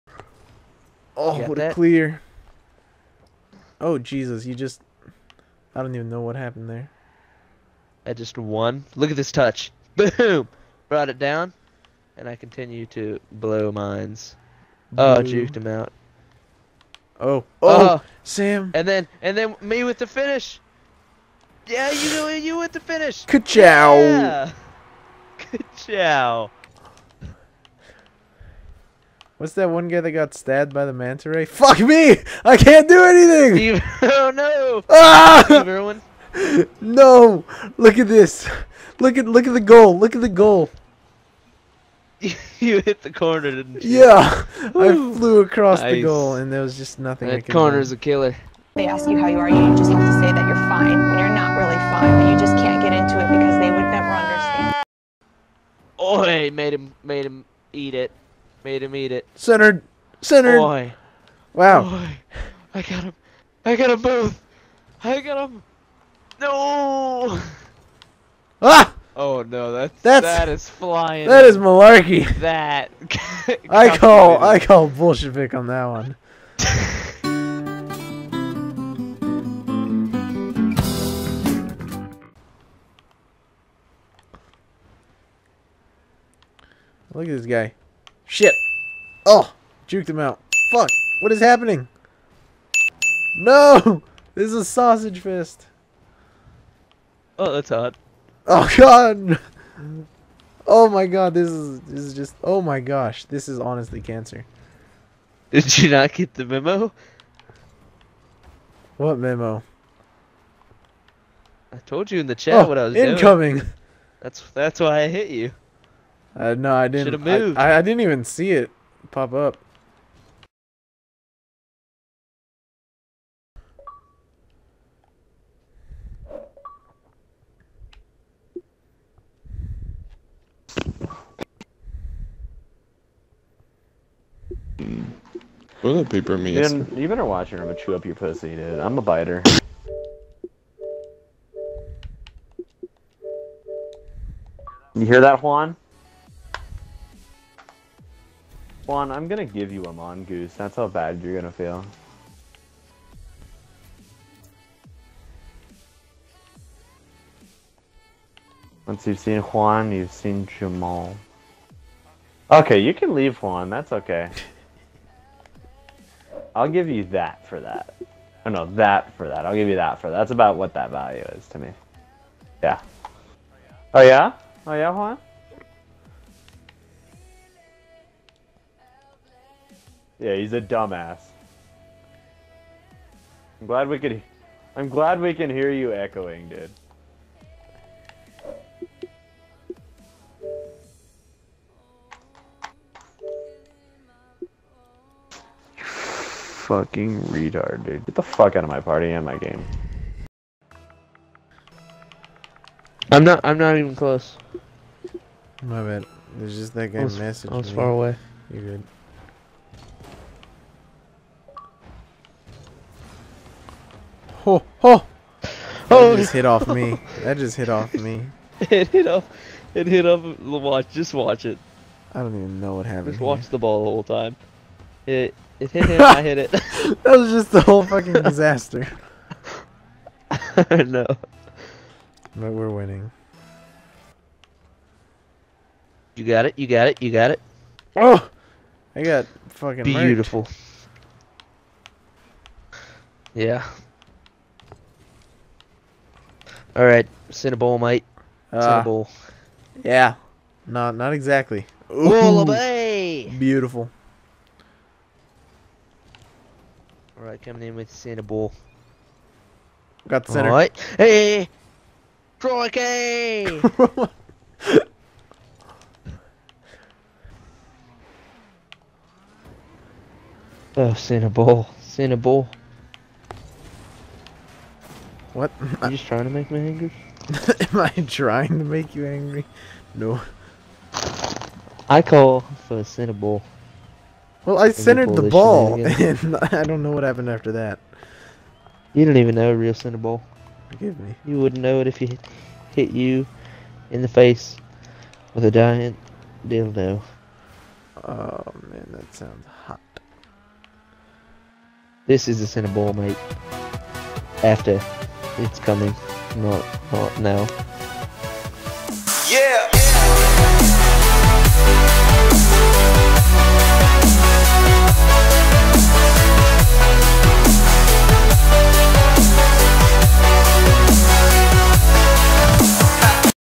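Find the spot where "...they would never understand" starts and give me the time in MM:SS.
00:53.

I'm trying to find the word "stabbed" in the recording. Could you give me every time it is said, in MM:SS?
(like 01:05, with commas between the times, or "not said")
00:30.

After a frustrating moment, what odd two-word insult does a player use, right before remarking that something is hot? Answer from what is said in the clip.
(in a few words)
sausage fist.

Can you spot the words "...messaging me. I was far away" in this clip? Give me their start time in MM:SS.
03:26.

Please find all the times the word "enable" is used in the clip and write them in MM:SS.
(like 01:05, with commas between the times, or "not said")
not said.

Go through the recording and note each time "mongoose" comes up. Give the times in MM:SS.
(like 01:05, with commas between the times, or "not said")
02:29.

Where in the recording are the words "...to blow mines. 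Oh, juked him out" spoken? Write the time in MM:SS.
00:12.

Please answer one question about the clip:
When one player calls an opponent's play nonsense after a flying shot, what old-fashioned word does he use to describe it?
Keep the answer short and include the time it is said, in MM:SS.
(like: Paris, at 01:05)
malarkey, at 01:11.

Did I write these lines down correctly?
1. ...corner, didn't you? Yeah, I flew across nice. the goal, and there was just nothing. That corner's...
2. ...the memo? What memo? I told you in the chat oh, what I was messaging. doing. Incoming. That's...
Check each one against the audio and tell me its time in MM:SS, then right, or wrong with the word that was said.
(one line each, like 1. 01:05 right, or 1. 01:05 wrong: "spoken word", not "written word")
1. 00:43 right
2. 01:46 wrong: "incoming", not "messaging".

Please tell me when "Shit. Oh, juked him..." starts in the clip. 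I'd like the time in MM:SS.
01:28.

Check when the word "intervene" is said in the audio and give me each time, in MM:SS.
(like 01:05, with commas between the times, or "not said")
not said.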